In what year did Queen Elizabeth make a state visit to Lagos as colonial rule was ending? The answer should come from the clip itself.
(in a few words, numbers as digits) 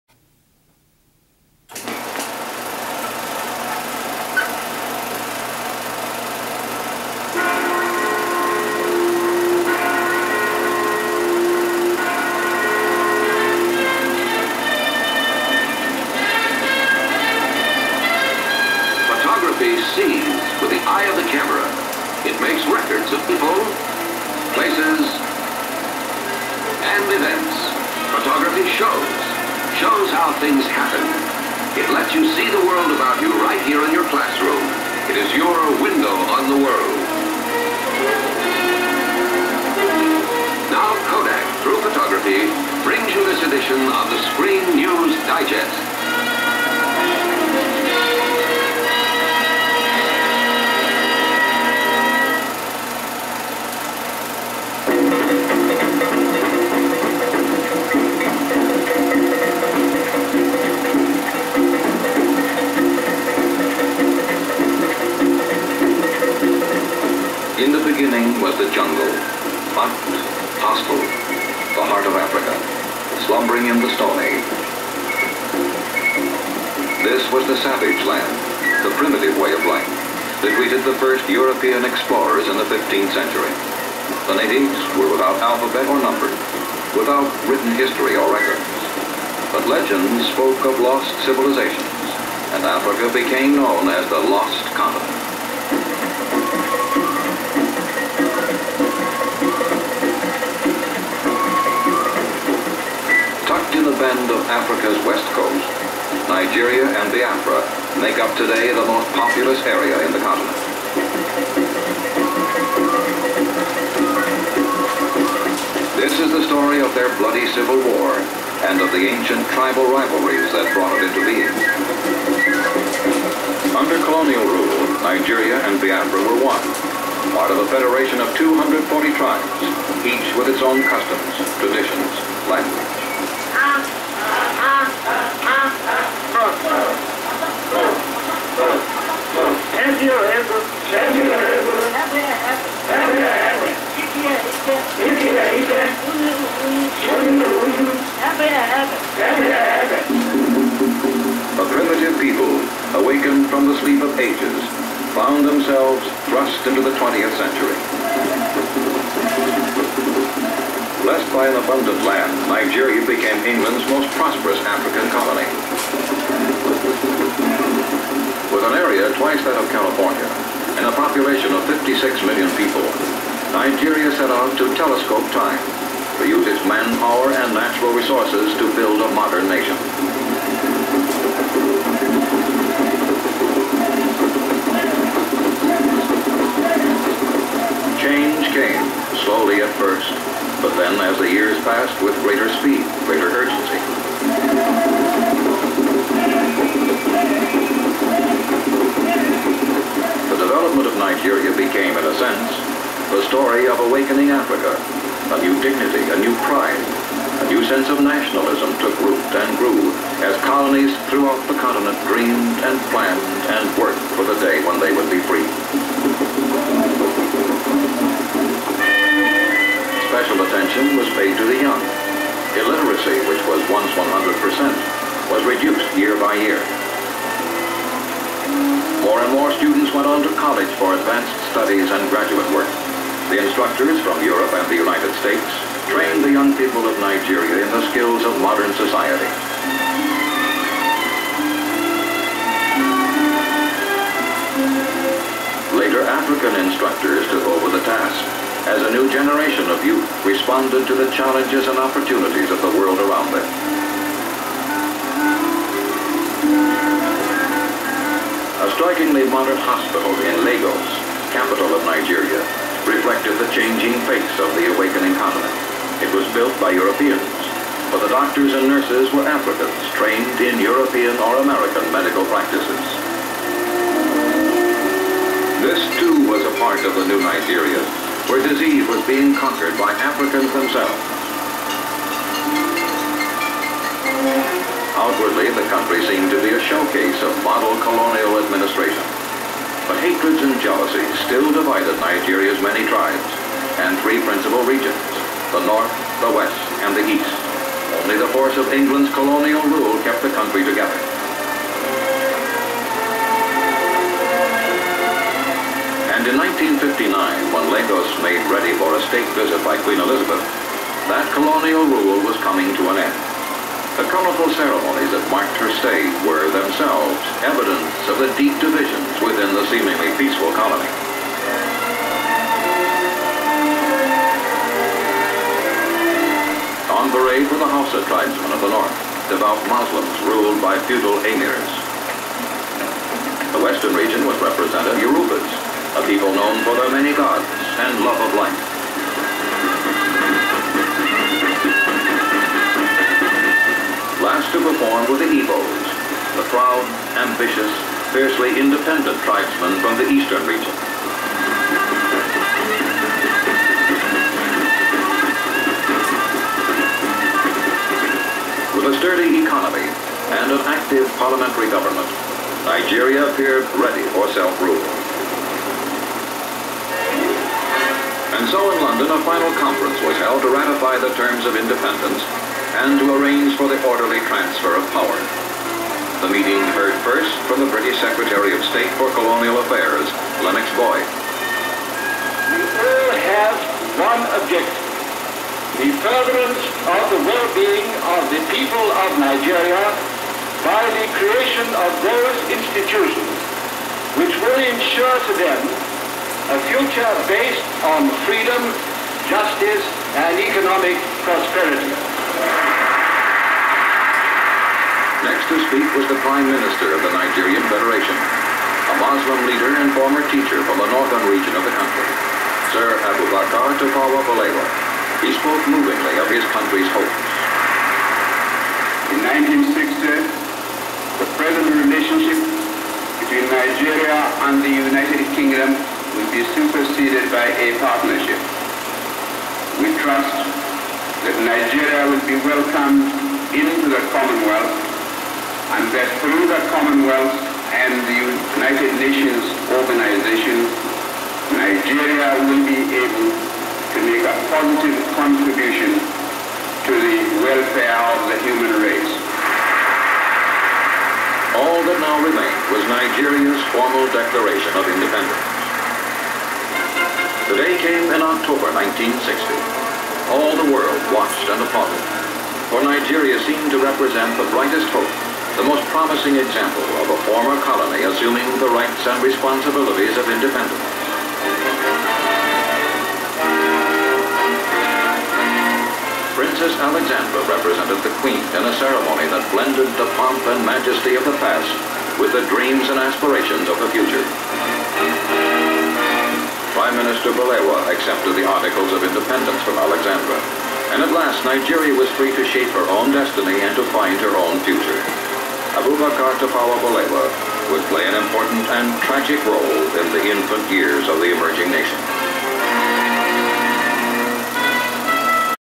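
1959.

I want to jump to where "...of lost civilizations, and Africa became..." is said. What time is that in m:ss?
1:30.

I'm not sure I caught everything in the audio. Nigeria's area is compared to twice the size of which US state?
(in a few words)
California.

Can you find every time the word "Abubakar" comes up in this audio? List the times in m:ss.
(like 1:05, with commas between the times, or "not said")
6:53, 8:15.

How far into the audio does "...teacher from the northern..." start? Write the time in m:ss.
6:50.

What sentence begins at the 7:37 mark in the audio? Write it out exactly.
The day came in October 1960 all the world watched and applauded.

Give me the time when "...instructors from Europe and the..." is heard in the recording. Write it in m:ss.
3:53.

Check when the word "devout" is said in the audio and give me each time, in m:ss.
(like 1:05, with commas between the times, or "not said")
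5:29.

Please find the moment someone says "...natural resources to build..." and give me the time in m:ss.
2:57.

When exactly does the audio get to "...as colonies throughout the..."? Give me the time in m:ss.
3:30.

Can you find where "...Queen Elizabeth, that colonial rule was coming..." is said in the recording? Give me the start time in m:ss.
5:09.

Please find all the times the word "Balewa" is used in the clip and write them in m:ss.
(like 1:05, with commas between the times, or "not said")
6:54, 8:07, 8:16.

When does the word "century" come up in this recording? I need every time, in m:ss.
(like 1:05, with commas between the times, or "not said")
1:23, 2:37.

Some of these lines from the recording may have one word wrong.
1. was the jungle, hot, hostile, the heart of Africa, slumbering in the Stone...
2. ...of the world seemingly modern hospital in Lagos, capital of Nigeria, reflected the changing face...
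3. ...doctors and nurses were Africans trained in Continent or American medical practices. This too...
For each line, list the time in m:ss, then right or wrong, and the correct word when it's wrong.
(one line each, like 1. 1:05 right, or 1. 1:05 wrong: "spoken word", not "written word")
1. 1:08 right
2. 4:12 wrong: "extremely", not "seemingly"
3. 4:28 wrong: "European", not "Continent".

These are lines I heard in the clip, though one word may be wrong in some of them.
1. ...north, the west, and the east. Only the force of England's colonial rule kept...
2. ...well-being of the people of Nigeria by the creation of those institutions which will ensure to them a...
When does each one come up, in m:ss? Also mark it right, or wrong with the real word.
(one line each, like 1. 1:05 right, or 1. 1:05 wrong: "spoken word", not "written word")
1. 4:55 right
2. 6:27 right.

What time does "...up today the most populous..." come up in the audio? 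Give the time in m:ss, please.
1:48.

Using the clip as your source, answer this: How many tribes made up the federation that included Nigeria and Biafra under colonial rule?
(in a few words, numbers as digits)
240.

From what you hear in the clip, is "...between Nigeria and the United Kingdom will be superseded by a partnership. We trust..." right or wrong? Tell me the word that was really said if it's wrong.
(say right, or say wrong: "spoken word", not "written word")
right.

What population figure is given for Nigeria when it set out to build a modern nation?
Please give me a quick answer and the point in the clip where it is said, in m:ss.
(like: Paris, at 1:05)
56 million, at 2:51.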